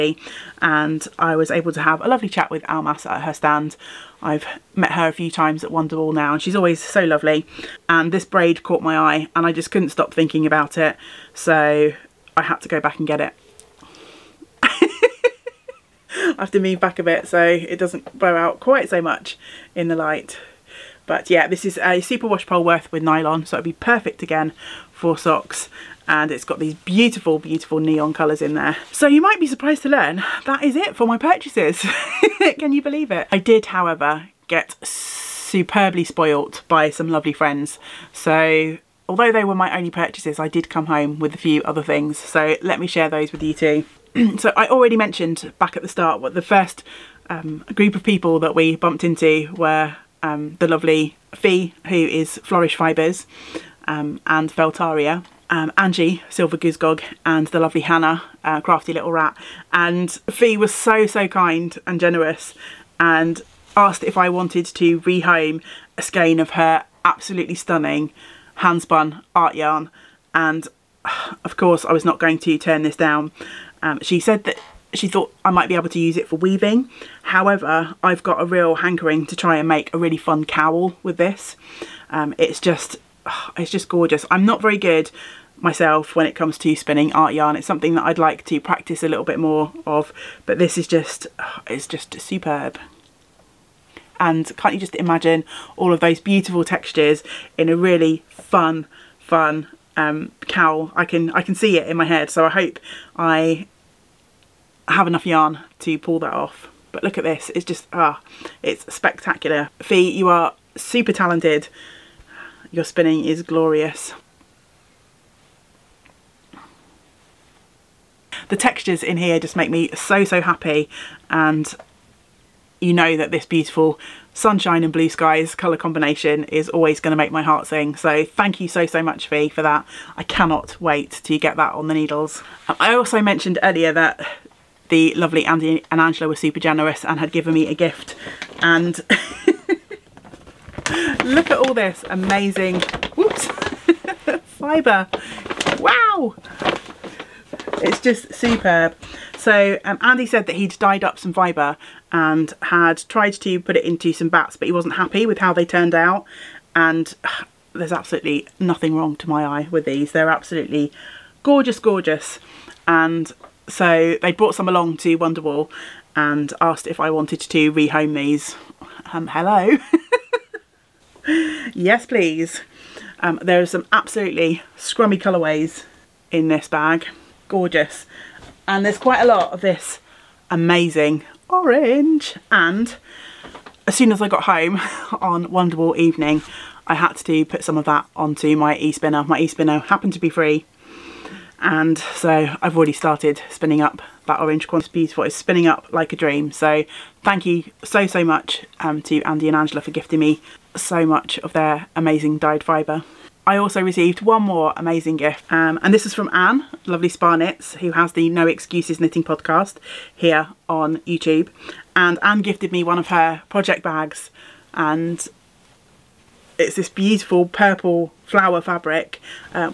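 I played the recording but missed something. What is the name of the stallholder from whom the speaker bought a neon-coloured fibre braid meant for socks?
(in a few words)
Almas.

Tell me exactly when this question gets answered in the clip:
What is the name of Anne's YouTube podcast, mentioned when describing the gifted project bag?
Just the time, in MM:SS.
03:28.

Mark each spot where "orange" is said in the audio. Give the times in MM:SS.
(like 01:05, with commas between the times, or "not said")
03:01, 03:14.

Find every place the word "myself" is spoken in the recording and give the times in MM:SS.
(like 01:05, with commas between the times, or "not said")
01:25.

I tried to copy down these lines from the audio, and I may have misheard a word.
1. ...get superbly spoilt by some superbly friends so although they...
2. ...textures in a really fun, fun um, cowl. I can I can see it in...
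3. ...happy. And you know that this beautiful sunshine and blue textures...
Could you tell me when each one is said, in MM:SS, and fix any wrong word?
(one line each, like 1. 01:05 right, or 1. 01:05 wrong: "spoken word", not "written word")
1. 00:34 wrong: "lovely", not "superbly"
2. 01:36 right
3. 02:00 wrong: "skies", not "textures".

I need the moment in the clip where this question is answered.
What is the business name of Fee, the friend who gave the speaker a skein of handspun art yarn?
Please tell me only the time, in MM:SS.
00:52.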